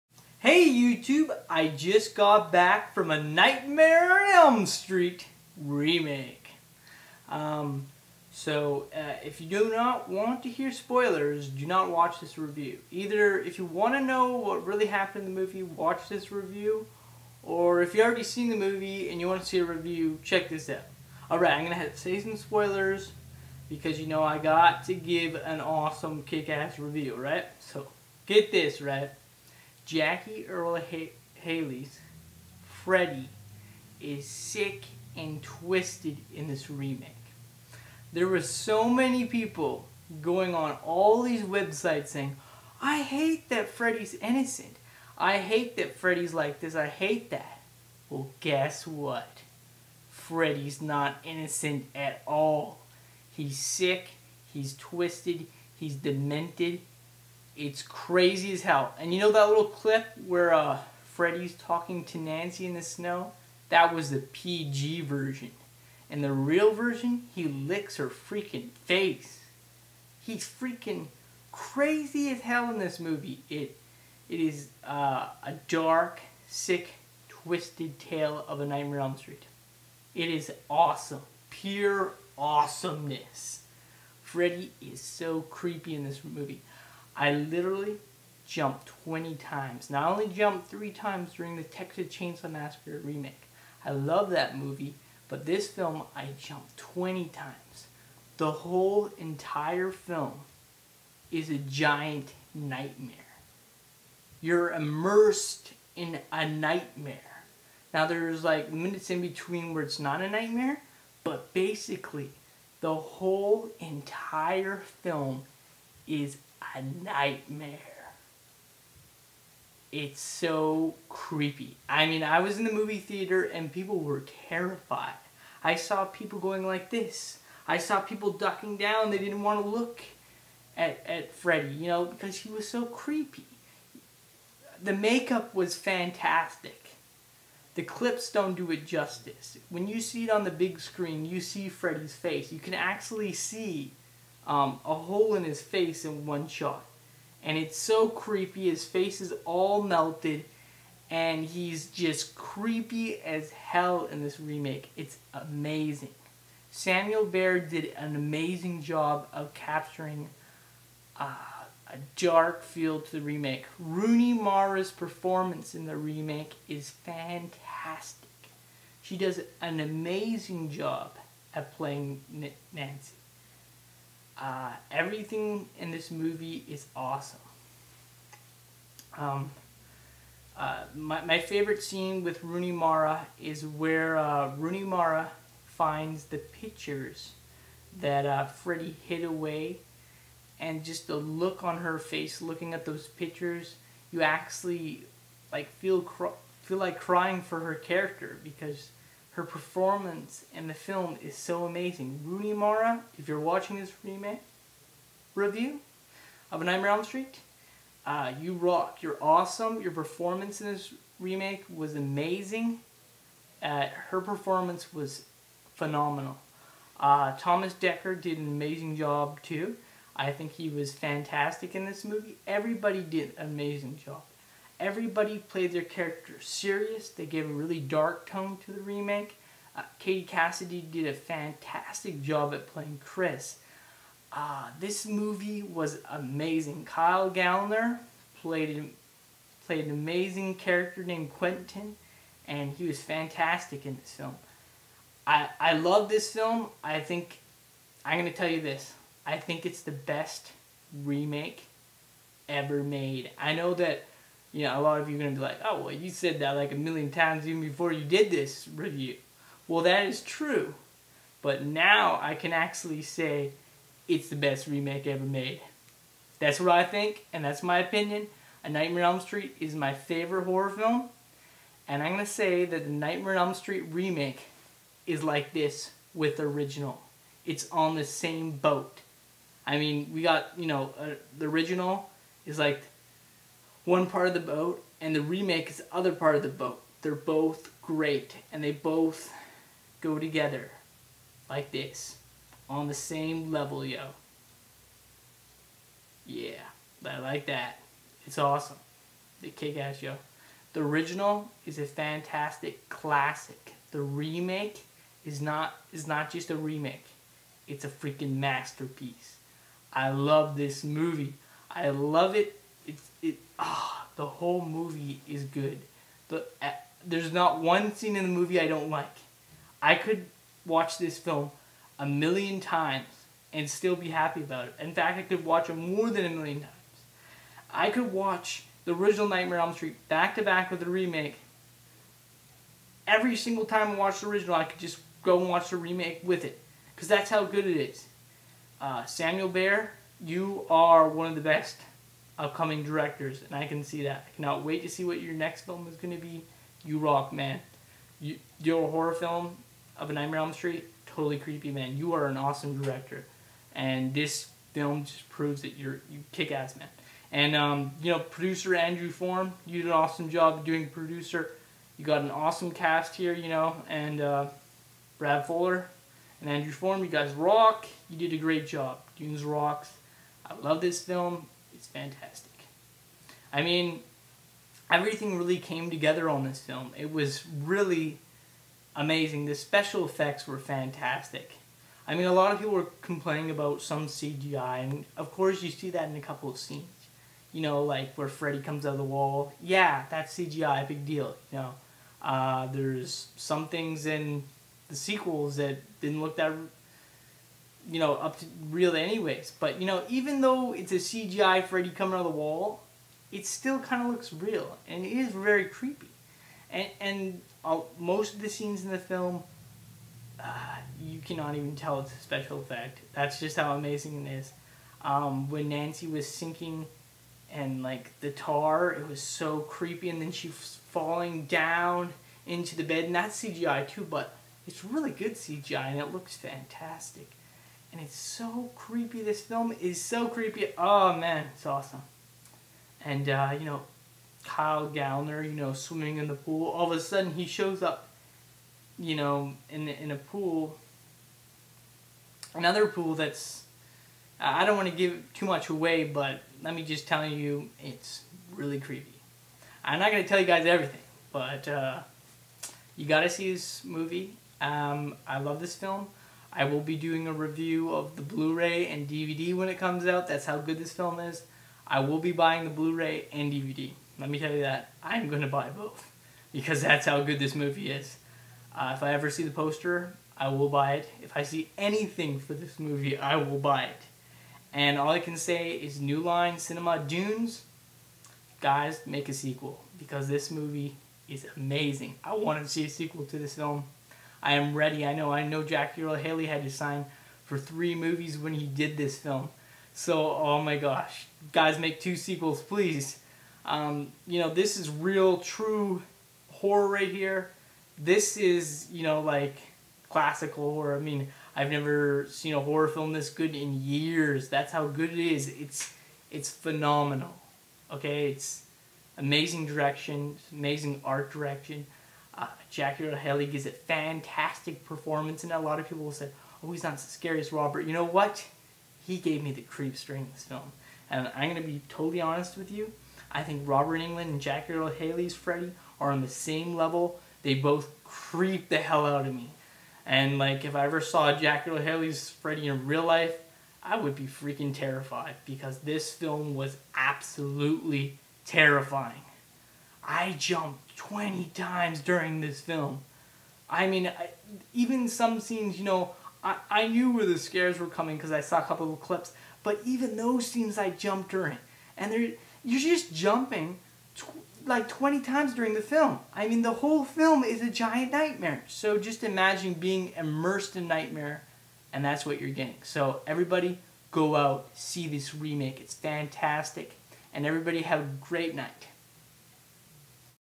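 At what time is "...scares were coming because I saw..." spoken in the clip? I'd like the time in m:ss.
9:07.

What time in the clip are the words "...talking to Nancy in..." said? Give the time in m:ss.
1:01.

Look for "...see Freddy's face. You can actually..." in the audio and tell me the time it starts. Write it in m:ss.
2:21.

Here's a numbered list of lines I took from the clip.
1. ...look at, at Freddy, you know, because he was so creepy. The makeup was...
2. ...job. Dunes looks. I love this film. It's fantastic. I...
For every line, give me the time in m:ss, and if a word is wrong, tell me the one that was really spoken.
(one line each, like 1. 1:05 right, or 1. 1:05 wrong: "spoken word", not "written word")
1. 2:09 right
2. 6:08 wrong: "rocks", not "looks".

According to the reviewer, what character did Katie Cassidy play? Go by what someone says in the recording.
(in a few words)
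Chris.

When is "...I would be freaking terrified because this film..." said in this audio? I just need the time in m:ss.
8:53.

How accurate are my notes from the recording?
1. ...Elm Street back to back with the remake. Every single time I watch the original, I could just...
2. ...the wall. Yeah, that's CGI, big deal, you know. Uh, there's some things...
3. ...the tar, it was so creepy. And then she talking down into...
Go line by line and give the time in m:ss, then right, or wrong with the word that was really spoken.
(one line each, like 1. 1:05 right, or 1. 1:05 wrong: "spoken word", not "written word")
1. 5:29 right
2. 6:28 right
3. 6:58 wrong: "falling", not "talking".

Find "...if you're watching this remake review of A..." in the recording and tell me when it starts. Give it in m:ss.
3:23.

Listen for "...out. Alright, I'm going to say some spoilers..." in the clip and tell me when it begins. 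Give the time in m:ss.
0:20.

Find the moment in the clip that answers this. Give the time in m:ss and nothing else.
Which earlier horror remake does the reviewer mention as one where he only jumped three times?
1:31.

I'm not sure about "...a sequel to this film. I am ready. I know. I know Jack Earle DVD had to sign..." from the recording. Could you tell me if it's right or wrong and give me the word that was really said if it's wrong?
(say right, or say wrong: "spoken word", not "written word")
wrong: "Haley", not "DVD".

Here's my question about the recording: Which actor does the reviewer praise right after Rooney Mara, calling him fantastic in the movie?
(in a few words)
Thomas Dekker.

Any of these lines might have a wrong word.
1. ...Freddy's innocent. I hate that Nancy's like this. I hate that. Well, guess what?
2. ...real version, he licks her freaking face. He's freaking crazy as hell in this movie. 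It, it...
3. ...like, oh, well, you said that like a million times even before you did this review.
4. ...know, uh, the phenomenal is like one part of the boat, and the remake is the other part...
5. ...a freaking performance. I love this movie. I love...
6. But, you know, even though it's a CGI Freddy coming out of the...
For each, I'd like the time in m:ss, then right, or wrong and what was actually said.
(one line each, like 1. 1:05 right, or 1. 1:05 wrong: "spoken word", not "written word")
1. 0:43 wrong: "Freddy", not "Nancy"
2. 1:06 right
3. 4:15 right
4. 4:40 wrong: "original", not "phenomenal"
5. 5:07 wrong: "masterpiece", not "performance"
6. 6:39 right.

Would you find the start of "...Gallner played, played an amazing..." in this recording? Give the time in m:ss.
3:57.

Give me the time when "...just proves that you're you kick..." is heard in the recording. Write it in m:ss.
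5:55.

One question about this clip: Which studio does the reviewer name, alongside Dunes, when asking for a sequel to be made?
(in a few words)
New Line Cinema.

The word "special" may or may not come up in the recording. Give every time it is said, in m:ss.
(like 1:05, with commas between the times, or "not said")
6:19, 6:52.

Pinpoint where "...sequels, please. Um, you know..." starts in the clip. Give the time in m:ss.
8:12.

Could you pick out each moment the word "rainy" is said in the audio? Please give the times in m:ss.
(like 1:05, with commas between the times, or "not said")
not said.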